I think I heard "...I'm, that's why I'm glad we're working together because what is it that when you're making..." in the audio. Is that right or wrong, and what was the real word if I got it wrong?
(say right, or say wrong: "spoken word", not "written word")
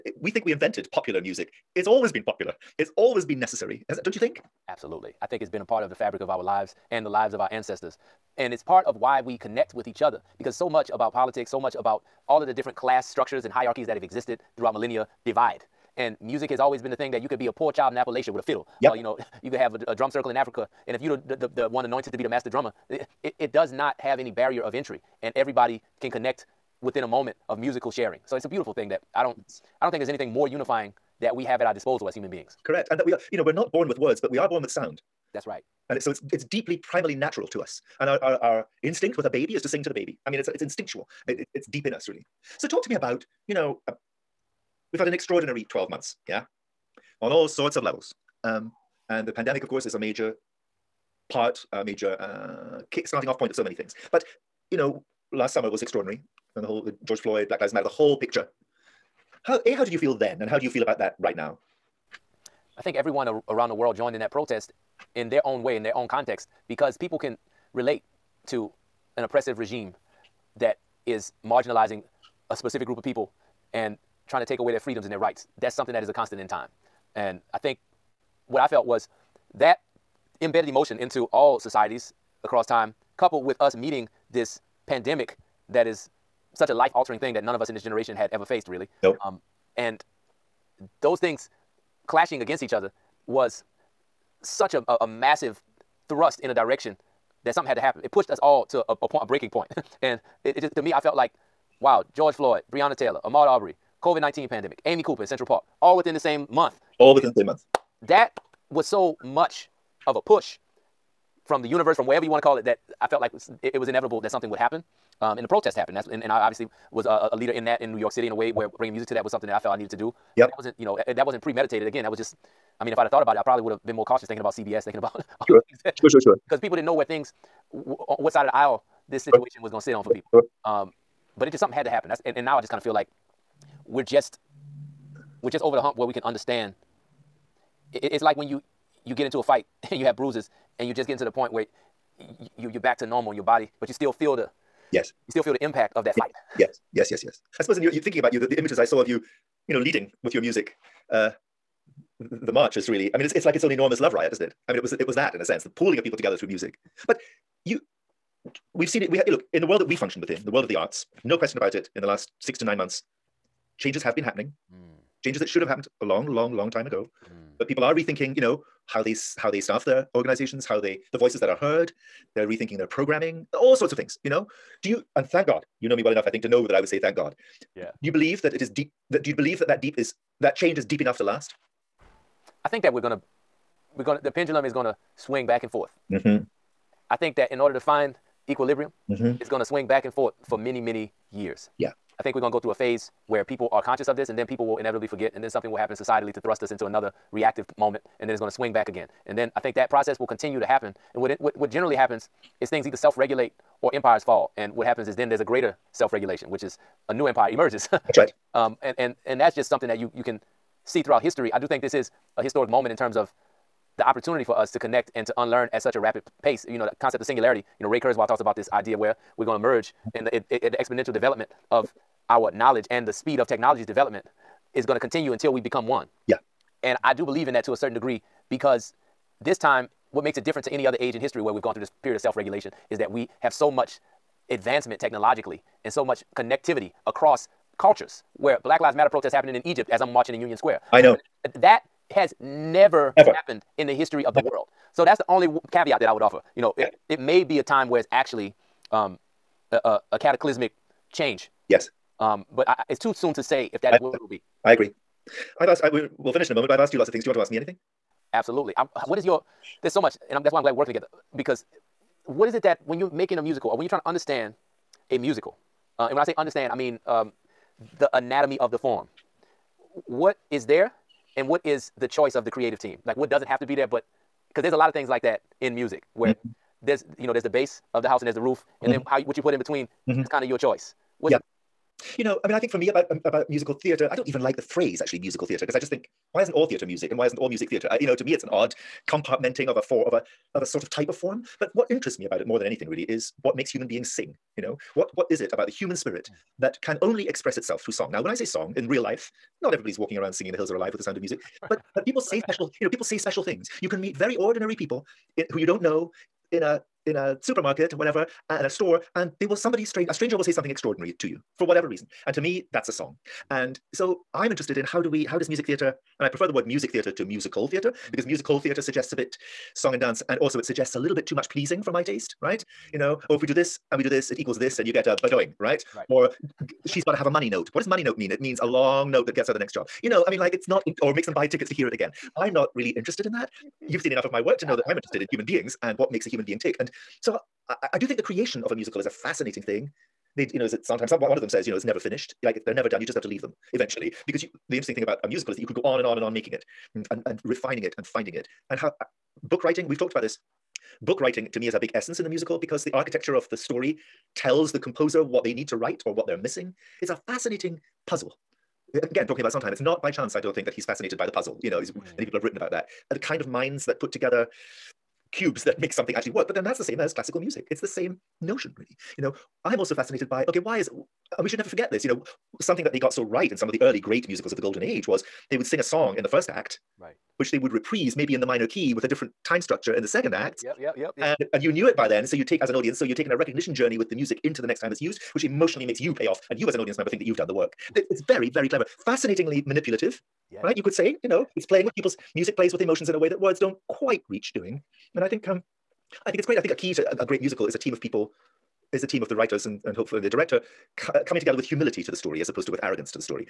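right.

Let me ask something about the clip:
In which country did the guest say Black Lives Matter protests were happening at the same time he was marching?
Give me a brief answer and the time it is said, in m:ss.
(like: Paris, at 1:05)
Egypt, at 3:59.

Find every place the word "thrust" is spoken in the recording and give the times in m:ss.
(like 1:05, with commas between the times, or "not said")
1:36, 3:16.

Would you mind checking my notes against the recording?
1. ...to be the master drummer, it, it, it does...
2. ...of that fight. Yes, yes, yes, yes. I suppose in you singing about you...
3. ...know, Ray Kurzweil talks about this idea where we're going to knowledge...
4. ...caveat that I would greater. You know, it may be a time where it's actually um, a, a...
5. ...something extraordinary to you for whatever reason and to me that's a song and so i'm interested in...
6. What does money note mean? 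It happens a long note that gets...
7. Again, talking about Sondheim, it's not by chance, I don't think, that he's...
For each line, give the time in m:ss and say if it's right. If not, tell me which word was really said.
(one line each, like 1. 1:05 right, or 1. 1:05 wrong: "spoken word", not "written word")
1. 0:22 right
2. 2:25 wrong: "thinking", not "singing"
3. 3:37 wrong: "merge", not "knowledge"
4. 4:05 wrong: "offer", not "greater"
5. 5:10 right
6. 5:27 wrong: "means", not "happens"
7. 5:58 right.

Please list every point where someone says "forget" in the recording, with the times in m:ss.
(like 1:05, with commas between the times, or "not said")
3:15, 6:11.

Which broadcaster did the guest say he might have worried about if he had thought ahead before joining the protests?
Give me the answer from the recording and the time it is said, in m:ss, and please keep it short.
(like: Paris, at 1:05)
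CBS, at 2:04.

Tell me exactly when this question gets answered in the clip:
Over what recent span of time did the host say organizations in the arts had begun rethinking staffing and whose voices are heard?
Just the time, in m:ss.
2:42.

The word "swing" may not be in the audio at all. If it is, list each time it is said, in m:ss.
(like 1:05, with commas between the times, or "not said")
3:05, 3:09, 3:18.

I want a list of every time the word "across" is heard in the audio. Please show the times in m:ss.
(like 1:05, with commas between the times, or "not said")
1:22, 3:57.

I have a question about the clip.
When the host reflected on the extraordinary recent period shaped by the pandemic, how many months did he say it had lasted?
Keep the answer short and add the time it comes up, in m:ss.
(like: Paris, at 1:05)
12 months, at 0:45.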